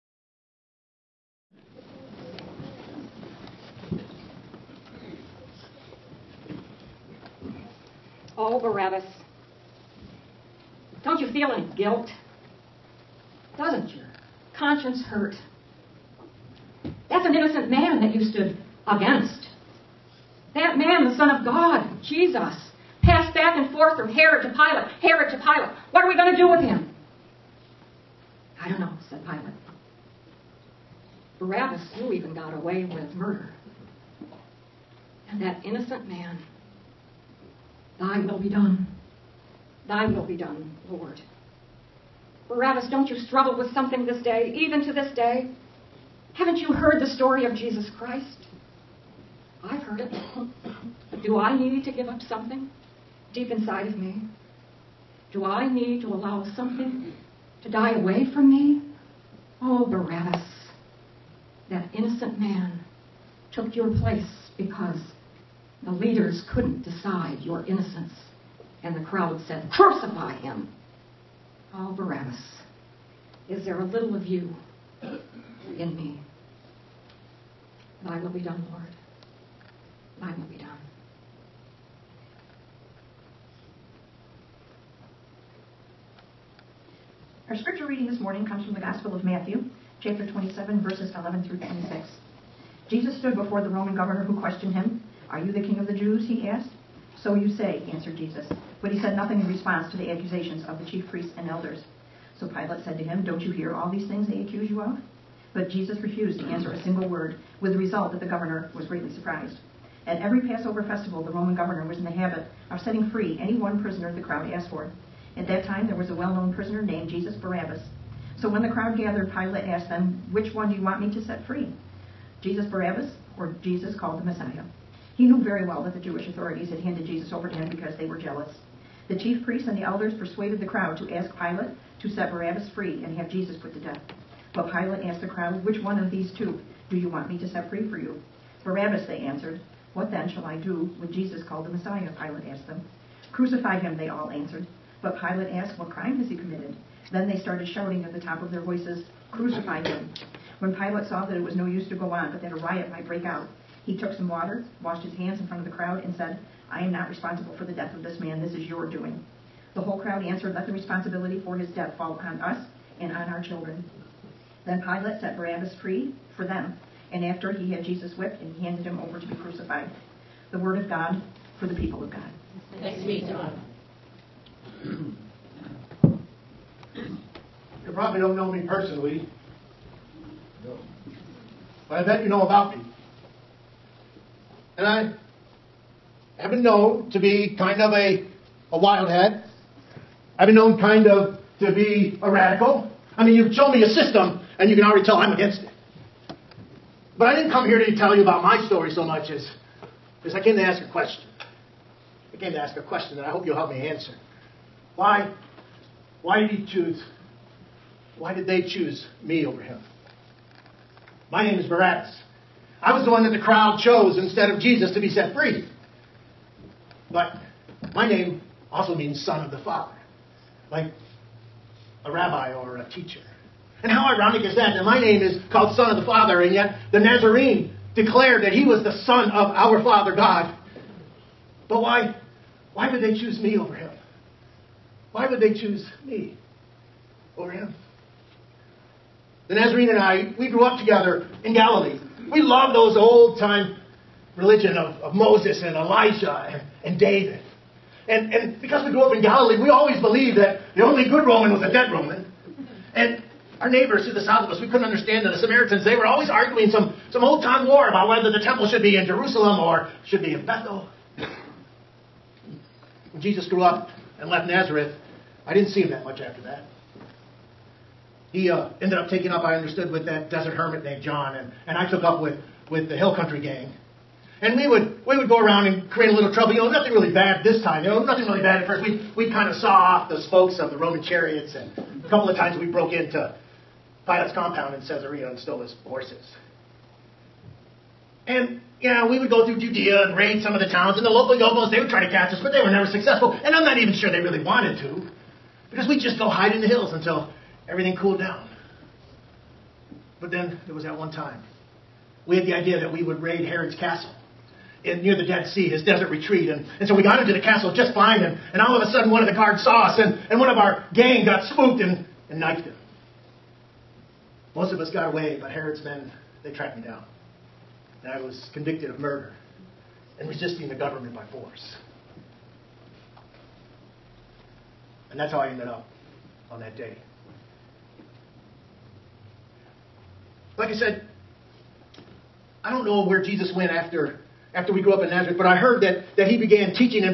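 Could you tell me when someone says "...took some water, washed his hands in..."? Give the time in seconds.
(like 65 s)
153 s.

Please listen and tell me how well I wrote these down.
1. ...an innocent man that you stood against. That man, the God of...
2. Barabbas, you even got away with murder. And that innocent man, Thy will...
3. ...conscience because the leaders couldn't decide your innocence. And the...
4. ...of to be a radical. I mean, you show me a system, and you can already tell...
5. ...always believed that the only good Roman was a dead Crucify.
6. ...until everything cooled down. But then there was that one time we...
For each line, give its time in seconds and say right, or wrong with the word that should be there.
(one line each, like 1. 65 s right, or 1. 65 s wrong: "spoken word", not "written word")
1. 17 s wrong: "Son", not "God"
2. 31 s right
3. 64 s wrong: "place", not "conscience"
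4. 191 s right
5. 249 s wrong: "Roman", not "Crucify"
6. 296 s right.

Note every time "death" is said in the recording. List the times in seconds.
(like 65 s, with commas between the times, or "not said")
133 s, 157 s, 161 s.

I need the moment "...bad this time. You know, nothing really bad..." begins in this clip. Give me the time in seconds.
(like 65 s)
277 s.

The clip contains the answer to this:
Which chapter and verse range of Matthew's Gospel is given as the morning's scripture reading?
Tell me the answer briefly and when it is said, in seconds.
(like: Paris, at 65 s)
27:11-26, at 90 s.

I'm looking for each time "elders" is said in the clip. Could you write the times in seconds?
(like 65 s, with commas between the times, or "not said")
101 s, 129 s.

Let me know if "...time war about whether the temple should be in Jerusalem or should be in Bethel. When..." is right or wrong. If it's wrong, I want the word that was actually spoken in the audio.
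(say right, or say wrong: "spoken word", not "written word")
right.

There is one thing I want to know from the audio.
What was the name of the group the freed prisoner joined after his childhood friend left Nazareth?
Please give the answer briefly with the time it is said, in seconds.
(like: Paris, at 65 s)
Hill Country Gang, at 272 s.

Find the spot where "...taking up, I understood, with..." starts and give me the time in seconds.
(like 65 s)
269 s.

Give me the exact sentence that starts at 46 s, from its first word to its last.
Haven't you heard the story of Jesus Christ?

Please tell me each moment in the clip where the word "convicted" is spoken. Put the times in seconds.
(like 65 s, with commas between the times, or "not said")
318 s.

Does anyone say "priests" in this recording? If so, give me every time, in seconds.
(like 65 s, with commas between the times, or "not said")
101 s, 129 s.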